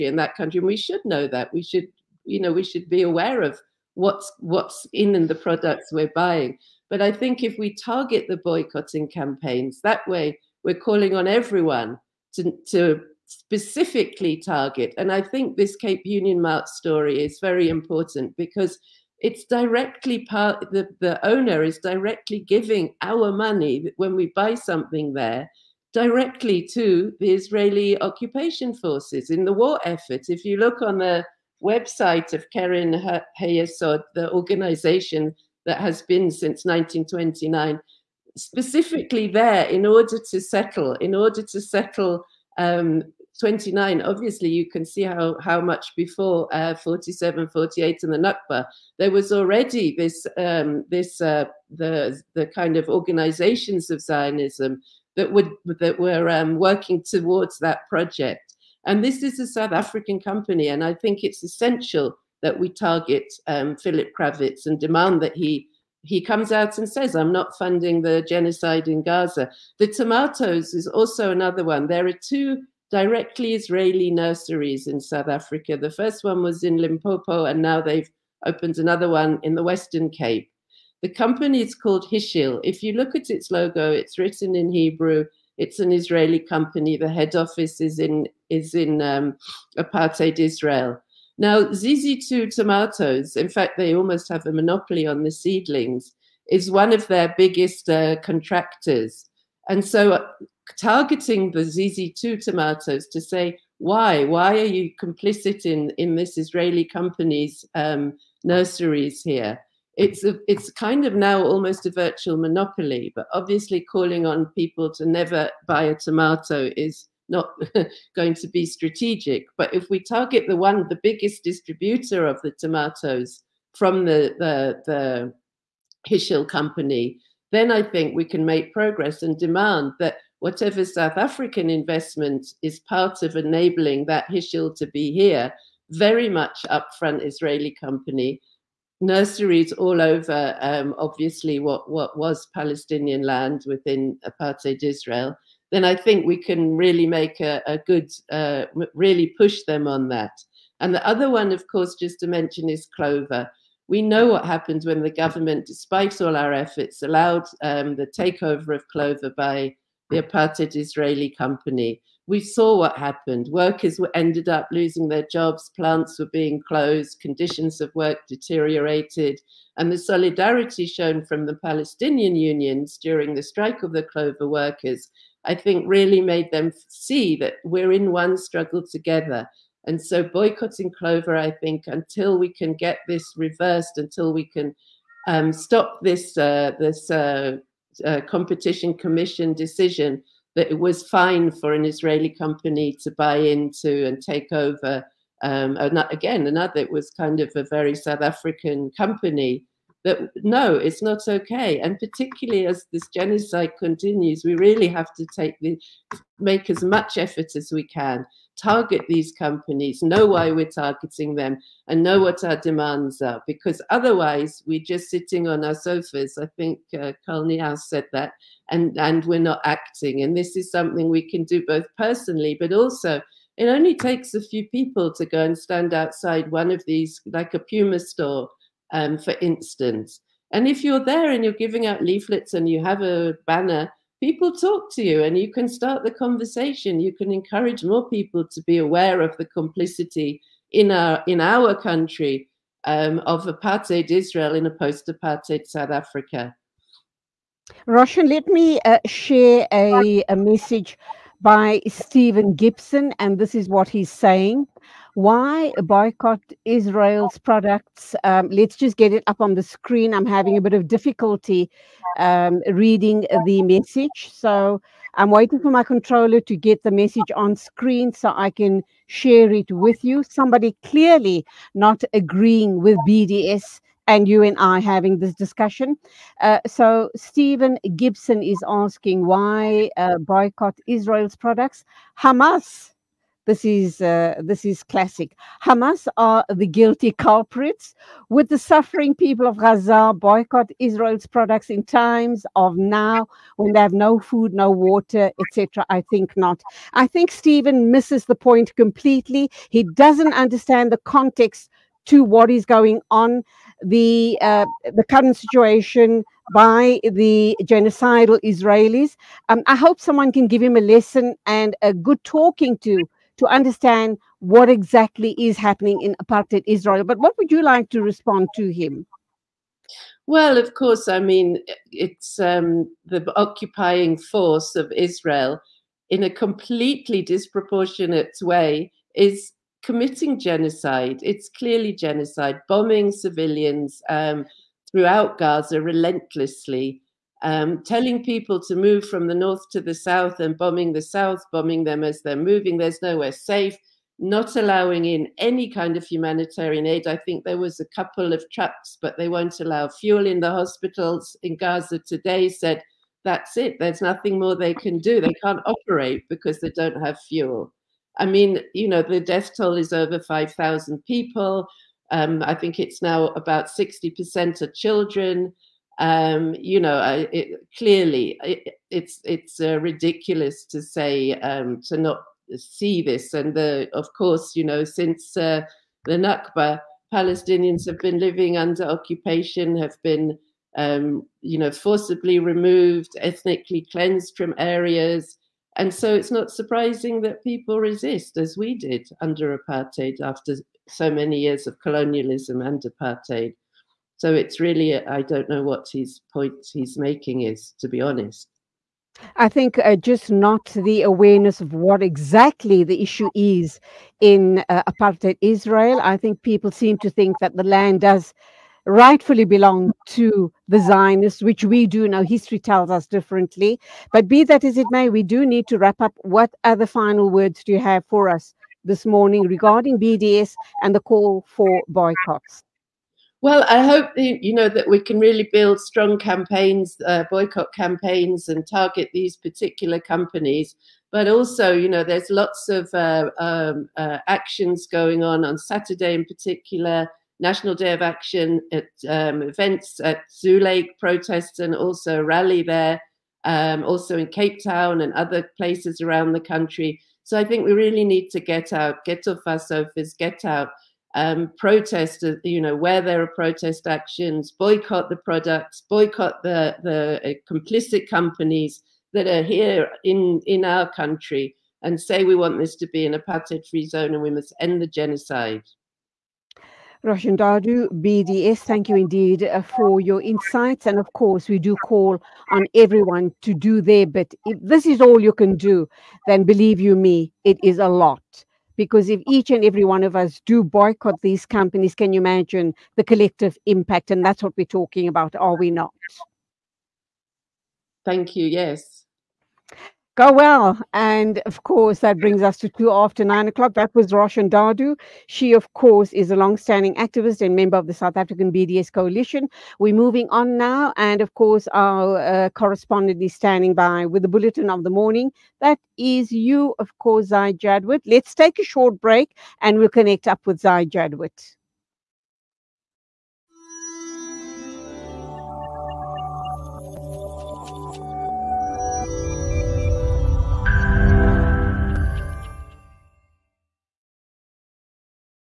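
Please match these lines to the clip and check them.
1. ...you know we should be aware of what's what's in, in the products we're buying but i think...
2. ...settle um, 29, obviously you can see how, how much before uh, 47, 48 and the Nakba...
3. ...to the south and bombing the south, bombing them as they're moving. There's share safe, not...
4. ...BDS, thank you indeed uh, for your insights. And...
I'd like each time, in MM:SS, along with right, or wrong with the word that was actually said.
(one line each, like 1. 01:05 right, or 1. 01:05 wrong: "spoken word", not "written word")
1. 00:02 right
2. 00:41 right
3. 05:39 wrong: "nowhere", not "share"
4. 07:48 right.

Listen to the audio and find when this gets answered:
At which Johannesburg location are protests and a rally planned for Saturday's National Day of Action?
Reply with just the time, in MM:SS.
07:20.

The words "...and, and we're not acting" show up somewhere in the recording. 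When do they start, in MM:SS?
03:38.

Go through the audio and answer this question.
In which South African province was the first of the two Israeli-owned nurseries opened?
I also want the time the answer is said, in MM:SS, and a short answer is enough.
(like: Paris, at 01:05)
Limpopo, at 01:16.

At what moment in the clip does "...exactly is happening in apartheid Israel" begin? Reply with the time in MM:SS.
05:14.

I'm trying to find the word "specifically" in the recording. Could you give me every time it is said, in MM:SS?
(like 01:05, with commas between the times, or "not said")
00:13, 00:38.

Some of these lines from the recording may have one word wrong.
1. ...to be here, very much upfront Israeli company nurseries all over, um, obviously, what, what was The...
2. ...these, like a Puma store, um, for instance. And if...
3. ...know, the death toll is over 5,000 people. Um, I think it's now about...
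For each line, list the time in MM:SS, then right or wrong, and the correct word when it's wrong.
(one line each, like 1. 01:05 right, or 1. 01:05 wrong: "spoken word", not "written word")
1. 02:14 wrong: "Palestinian", not "The"
2. 03:46 right
3. 05:58 right.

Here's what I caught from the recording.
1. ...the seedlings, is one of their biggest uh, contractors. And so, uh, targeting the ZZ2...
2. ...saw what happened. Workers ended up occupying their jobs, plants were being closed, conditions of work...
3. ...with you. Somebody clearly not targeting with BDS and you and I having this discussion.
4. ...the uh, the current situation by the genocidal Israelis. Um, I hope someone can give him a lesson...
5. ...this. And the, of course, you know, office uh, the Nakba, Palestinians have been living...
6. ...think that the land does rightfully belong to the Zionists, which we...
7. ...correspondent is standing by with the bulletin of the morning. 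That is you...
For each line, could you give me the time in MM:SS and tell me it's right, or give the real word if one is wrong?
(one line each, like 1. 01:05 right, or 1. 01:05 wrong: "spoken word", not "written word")
1. 01:35 right
2. 02:42 wrong: "losing", not "occupying"
3. 04:29 wrong: "agreeing", not "targeting"
4. 05:03 right
5. 06:13 wrong: "since", not "office"
6. 06:47 right
7. 08:22 right.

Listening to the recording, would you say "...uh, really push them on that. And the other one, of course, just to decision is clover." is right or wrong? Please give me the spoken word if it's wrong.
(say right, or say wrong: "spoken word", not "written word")
wrong: "mention", not "decision".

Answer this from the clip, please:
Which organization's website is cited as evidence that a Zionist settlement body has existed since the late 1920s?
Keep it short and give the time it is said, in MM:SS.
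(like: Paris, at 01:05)
Keren Hayesod, at 00:32.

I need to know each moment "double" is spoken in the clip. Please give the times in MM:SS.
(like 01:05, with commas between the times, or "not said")
not said.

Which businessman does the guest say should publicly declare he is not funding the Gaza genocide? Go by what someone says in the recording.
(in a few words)
Philip Krawitz.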